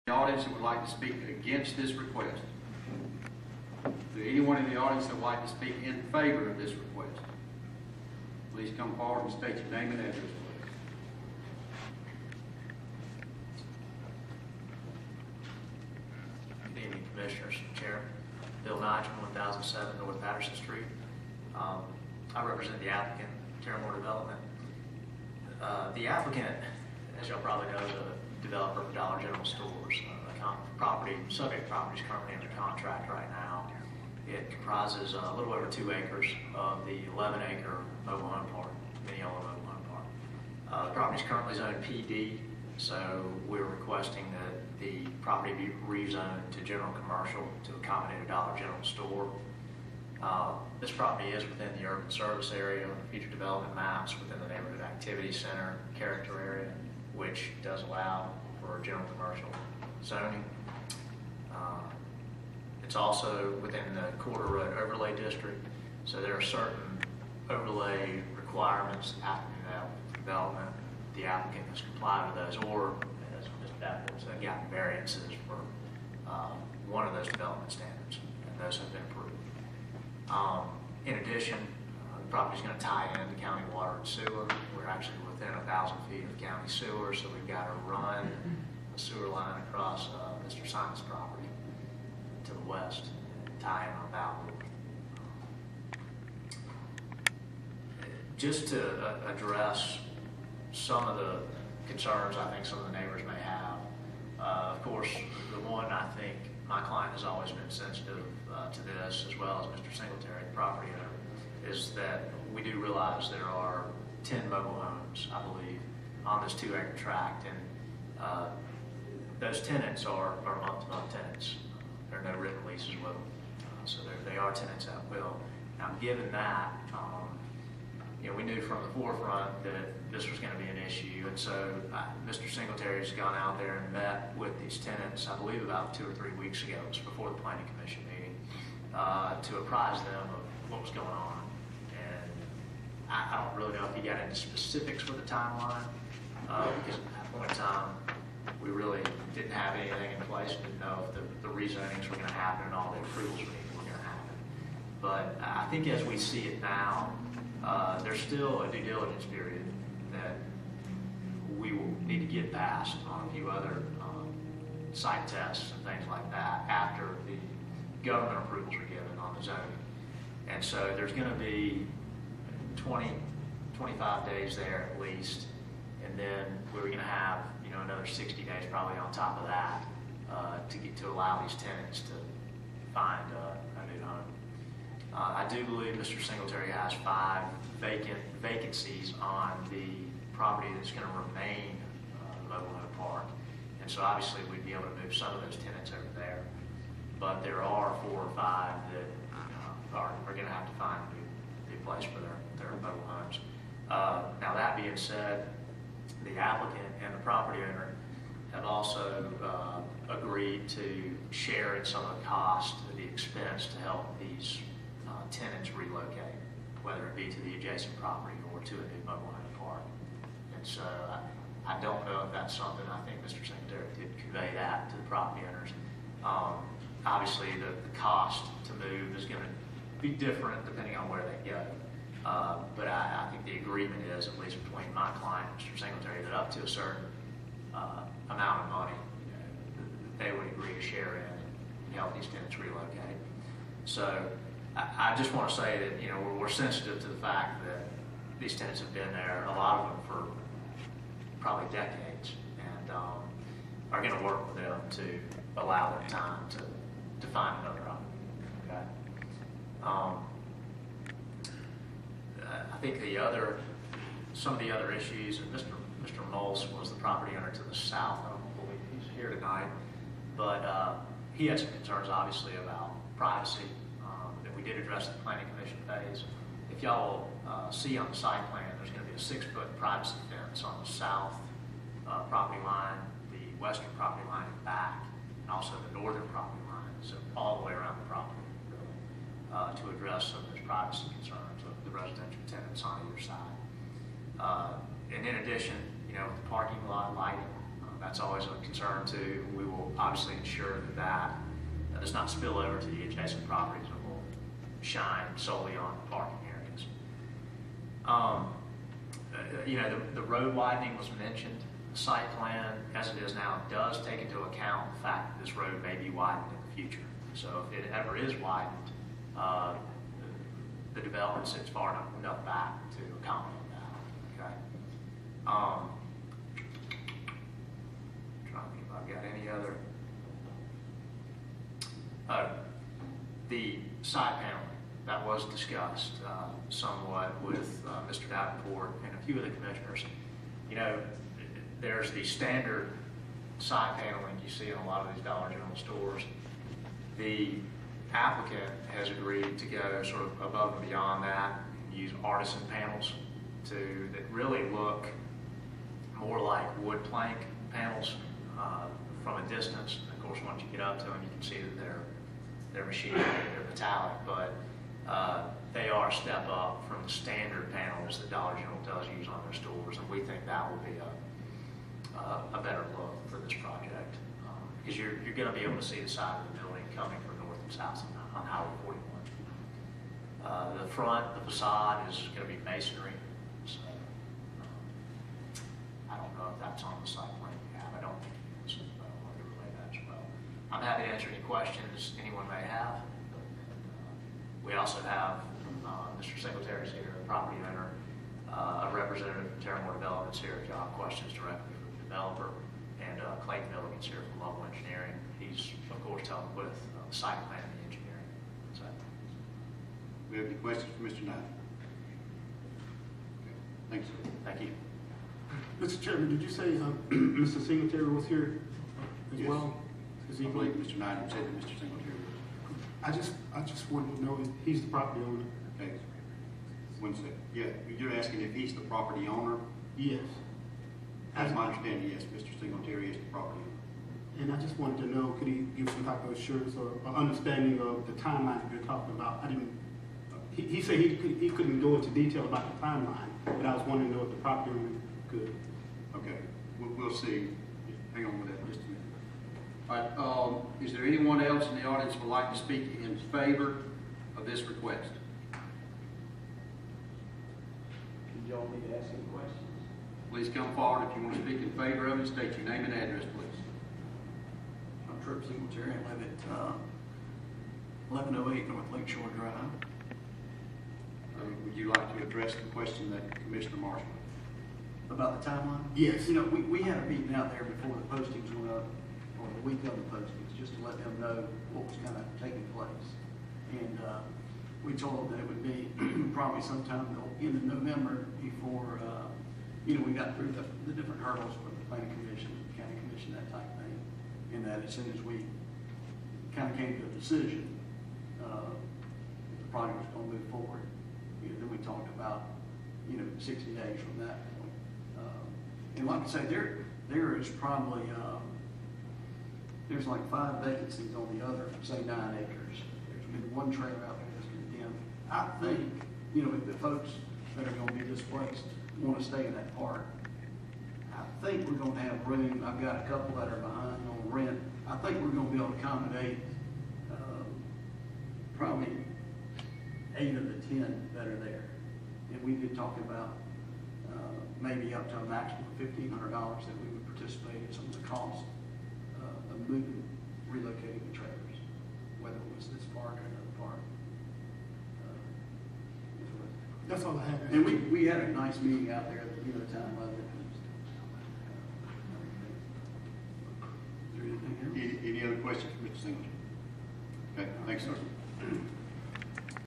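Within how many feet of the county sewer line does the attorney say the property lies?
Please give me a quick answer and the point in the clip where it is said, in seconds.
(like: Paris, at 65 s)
1,000 feet, at 85 s.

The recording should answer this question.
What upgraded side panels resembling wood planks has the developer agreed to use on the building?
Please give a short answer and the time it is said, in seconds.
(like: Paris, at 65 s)
artisan panels, at 352 s.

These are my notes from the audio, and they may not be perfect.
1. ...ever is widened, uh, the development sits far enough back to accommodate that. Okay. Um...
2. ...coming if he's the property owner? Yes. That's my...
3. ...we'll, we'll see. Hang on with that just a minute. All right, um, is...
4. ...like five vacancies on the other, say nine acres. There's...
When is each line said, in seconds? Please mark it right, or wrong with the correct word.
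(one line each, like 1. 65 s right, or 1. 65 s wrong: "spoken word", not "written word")
1. 317 s right
2. 428 s wrong: "asking", not "coming"
3. 446 s right
4. 510 s right.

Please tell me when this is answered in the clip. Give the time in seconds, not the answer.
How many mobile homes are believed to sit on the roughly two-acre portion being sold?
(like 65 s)
114 s.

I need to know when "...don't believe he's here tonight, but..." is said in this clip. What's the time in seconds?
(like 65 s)
268 s.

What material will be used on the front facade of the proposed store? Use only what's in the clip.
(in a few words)
masonry.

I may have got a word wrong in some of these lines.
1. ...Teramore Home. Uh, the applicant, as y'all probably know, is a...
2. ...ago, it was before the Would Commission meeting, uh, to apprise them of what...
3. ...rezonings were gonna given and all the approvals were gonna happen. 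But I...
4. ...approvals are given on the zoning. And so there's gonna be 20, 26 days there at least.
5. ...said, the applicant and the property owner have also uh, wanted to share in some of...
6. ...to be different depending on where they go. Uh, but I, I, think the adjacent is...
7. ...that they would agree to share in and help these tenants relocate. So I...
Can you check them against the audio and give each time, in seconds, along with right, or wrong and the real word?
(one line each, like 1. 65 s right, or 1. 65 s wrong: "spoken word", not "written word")
1. 23 s wrong: "Development", not "Home"
2. 136 s wrong: "Planning", not "Would"
3. 151 s wrong: "happen", not "given"
4. 168 s wrong: "25", not "26"
5. 204 s wrong: "agreed", not "wanted"
6. 229 s wrong: "agreement", not "adjacent"
7. 240 s right.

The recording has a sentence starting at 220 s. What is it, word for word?
And so I, uh, I don't know if that's something I think Mr.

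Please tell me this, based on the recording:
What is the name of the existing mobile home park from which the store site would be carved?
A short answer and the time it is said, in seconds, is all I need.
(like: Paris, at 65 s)
Mineola Mobile Home Park, at 39 s.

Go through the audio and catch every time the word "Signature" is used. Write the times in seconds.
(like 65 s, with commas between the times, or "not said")
465 s.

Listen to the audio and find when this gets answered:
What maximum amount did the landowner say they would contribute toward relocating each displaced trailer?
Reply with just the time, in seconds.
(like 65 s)
535 s.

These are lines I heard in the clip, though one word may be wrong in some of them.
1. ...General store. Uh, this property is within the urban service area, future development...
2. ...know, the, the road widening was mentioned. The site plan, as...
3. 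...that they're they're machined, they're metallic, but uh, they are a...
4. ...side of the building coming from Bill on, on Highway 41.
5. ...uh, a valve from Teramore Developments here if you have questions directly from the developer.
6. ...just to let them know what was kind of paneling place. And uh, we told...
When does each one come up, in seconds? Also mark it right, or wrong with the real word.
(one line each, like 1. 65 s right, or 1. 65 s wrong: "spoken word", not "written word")
1. 48 s right
2. 309 s right
3. 361 s right
4. 376 s wrong: "House", not "Bill"
5. 398 s wrong: "representative", not "valve"
6. 480 s wrong: "taking", not "paneling".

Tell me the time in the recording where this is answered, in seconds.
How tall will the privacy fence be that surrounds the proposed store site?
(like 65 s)
279 s.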